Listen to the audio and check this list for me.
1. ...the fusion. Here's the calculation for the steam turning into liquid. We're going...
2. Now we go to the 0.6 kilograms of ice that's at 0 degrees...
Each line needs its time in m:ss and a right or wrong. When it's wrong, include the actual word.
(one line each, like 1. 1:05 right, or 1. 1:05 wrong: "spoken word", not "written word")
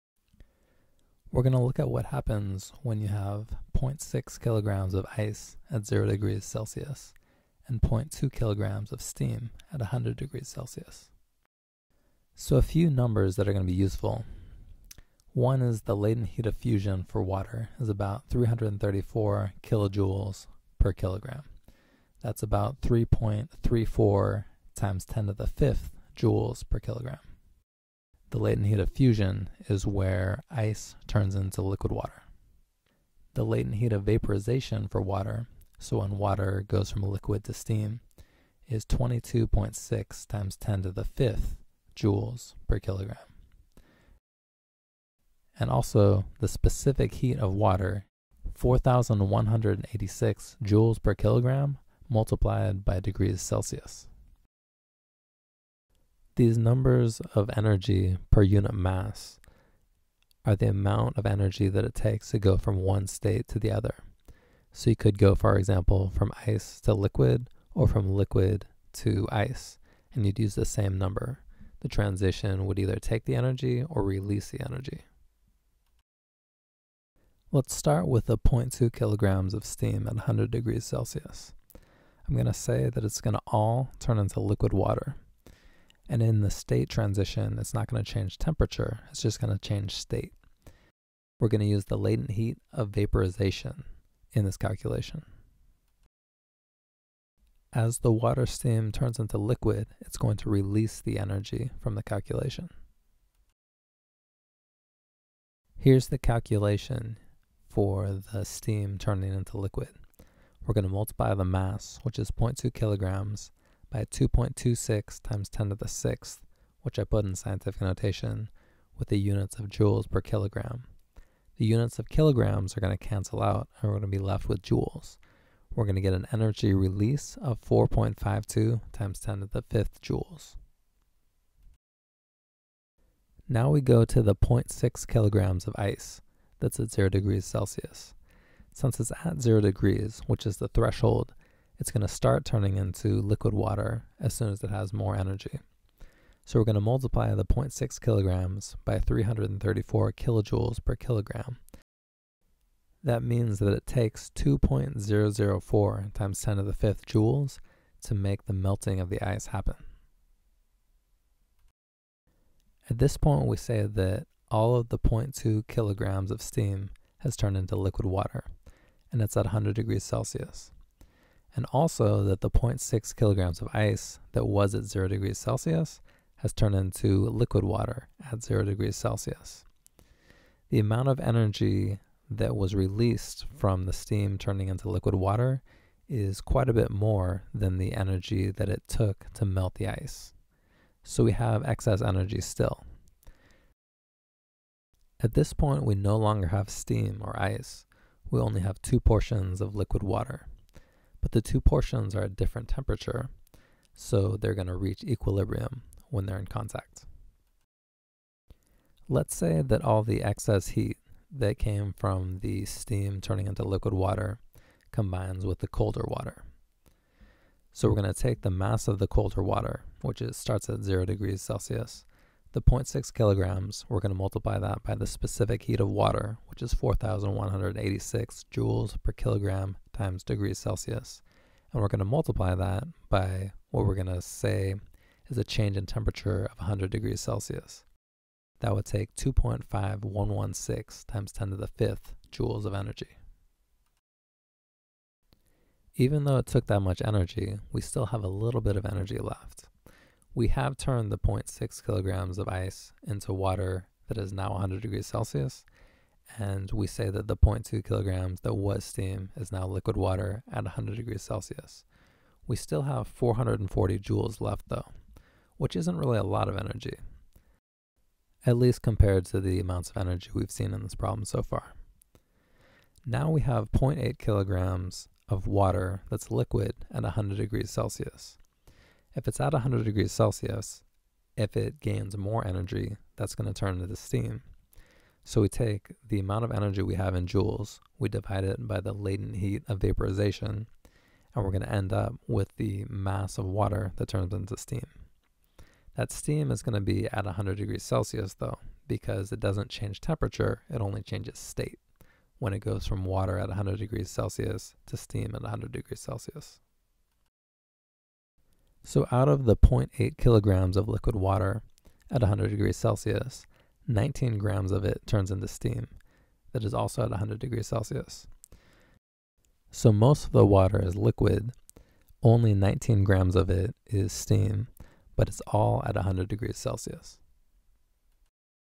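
1. 1:41 wrong: "calculation", not "fusion"
2. 2:13 right.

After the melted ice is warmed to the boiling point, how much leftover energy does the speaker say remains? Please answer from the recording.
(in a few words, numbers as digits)
440 joules.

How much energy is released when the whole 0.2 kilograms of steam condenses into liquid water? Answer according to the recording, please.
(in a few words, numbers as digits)
4.52 × 10^5 joules.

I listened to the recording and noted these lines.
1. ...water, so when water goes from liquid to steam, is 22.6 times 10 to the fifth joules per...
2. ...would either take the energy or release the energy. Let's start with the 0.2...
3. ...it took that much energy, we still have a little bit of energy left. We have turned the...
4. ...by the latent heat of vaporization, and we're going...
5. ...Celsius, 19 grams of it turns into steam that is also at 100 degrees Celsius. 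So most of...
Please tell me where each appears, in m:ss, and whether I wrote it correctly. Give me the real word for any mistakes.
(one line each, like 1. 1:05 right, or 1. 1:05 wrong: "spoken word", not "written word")
1. 0:35 right
2. 1:12 right
3. 4:06 right
4. 4:48 right
5. 5:12 right.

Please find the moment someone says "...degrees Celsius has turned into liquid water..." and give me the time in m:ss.
2:55.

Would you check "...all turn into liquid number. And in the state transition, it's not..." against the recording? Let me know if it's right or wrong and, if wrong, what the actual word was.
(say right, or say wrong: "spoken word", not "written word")
wrong: "water", not "number".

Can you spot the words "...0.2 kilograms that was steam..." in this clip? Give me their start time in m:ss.
4:17.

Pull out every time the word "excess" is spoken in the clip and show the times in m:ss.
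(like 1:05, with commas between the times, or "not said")
3:11, 3:30.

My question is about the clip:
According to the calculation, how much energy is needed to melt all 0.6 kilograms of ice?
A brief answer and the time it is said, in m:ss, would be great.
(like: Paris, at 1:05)
2.004 × 10^5 joules, at 2:34.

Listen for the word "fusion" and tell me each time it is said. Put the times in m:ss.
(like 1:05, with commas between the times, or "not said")
0:16, 0:28.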